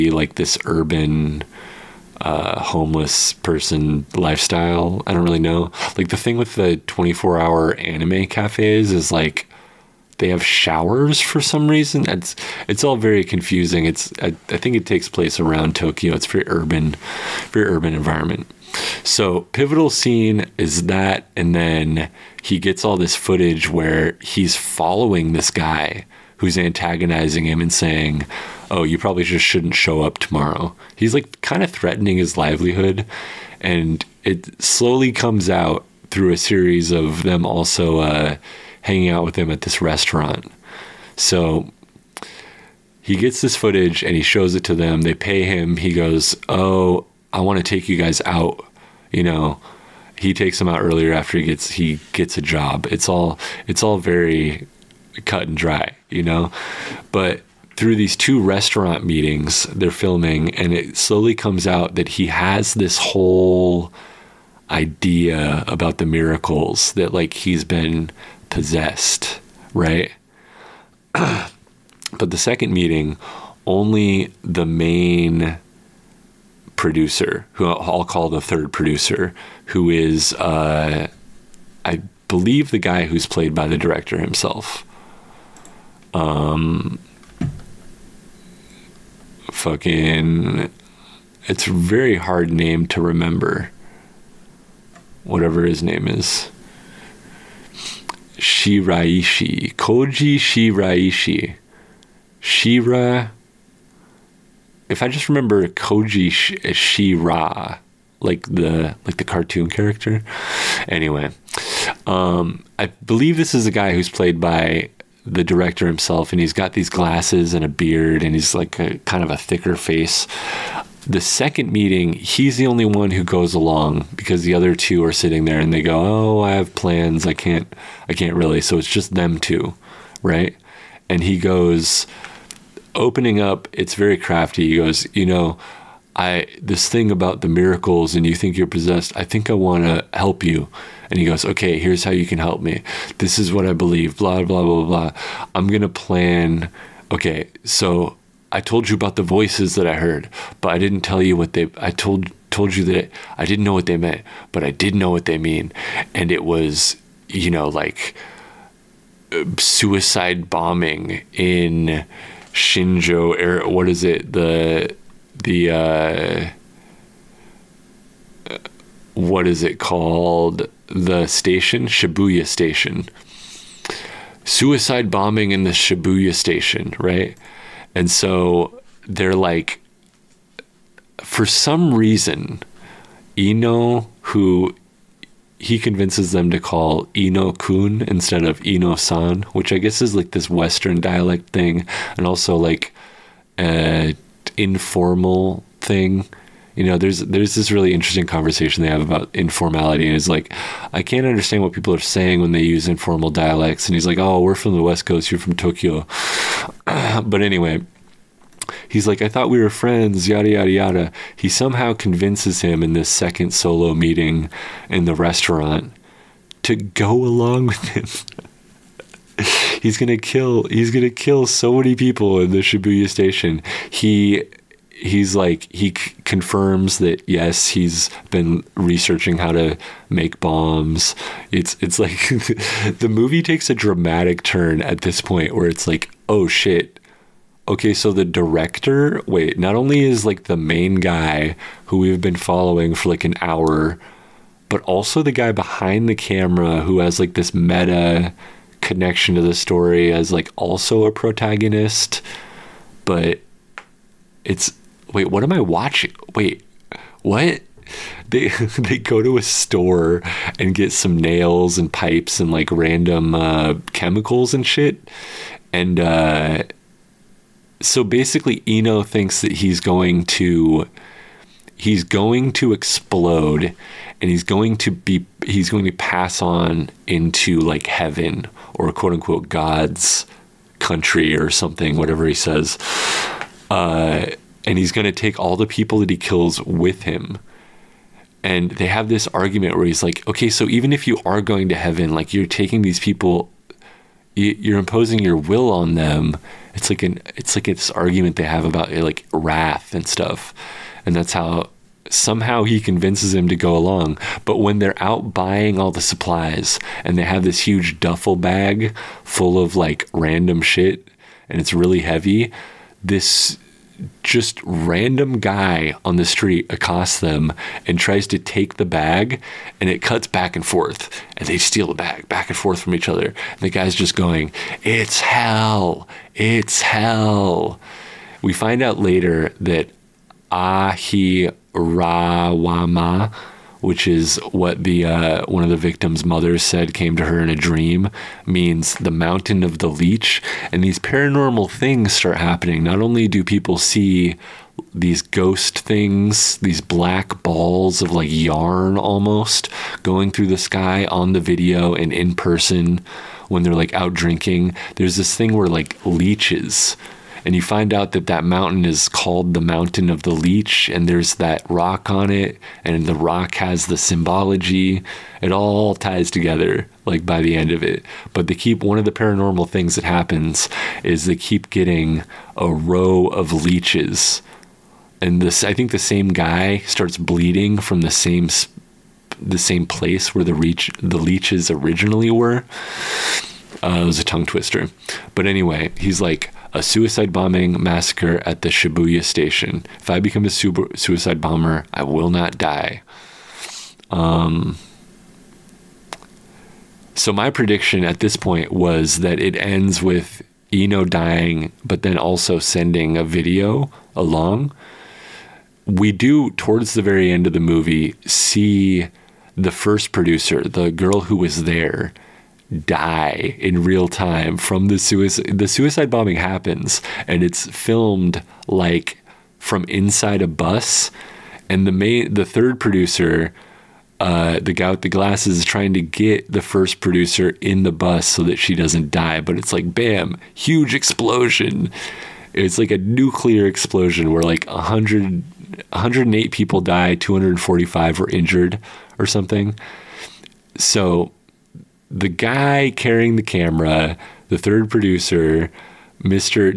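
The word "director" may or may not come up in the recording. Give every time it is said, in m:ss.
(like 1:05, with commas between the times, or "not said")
1:23, 1:55, 3:58.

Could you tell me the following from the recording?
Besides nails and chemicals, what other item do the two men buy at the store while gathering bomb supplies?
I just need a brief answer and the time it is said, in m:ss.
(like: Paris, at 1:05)
pipes, at 4:21.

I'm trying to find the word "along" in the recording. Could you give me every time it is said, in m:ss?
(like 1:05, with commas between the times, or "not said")
2:03, 3:37, 5:03, 6:44.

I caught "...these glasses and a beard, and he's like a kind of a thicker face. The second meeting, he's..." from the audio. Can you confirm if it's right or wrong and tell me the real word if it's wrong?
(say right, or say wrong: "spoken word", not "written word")
right.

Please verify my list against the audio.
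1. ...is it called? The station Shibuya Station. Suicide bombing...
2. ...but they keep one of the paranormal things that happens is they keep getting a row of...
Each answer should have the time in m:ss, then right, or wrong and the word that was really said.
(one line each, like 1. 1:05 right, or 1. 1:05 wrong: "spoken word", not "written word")
1. 2:49 right
2. 6:08 right.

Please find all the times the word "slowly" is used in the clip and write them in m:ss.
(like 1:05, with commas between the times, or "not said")
0:34, 1:00.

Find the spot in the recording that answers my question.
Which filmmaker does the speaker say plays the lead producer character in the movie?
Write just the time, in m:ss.
1:39.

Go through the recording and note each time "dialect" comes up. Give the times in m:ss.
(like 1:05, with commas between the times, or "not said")
3:10, 3:23.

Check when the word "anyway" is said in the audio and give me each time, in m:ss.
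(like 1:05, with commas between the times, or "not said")
1:50, 3:27, 6:25.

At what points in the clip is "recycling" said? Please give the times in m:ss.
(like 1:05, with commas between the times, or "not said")
not said.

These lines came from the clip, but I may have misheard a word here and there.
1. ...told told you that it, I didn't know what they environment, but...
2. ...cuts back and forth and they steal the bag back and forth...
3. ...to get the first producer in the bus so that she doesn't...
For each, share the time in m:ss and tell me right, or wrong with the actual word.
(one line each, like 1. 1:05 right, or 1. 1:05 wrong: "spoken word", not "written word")
1. 2:31 wrong: "meant", not "environment"
2. 5:20 right
3. 7:05 right.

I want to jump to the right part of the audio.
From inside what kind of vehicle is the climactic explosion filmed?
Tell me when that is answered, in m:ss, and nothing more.
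7:00.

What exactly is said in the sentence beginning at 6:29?
If I become a suicide bomber, I will not die.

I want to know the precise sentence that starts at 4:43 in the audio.
Uh, and he's going to take all the people that he kills with him.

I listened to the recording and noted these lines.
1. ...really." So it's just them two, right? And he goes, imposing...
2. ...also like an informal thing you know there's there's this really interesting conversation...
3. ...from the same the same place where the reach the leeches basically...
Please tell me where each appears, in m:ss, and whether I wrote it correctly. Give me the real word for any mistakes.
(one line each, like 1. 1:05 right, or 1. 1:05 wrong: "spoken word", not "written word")
1. 2:08 wrong: "opening", not "imposing"
2. 3:12 right
3. 6:17 wrong: "originally", not "basically".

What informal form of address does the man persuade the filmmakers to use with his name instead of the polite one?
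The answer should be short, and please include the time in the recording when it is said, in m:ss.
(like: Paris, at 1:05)
Eno Kun, at 3:07.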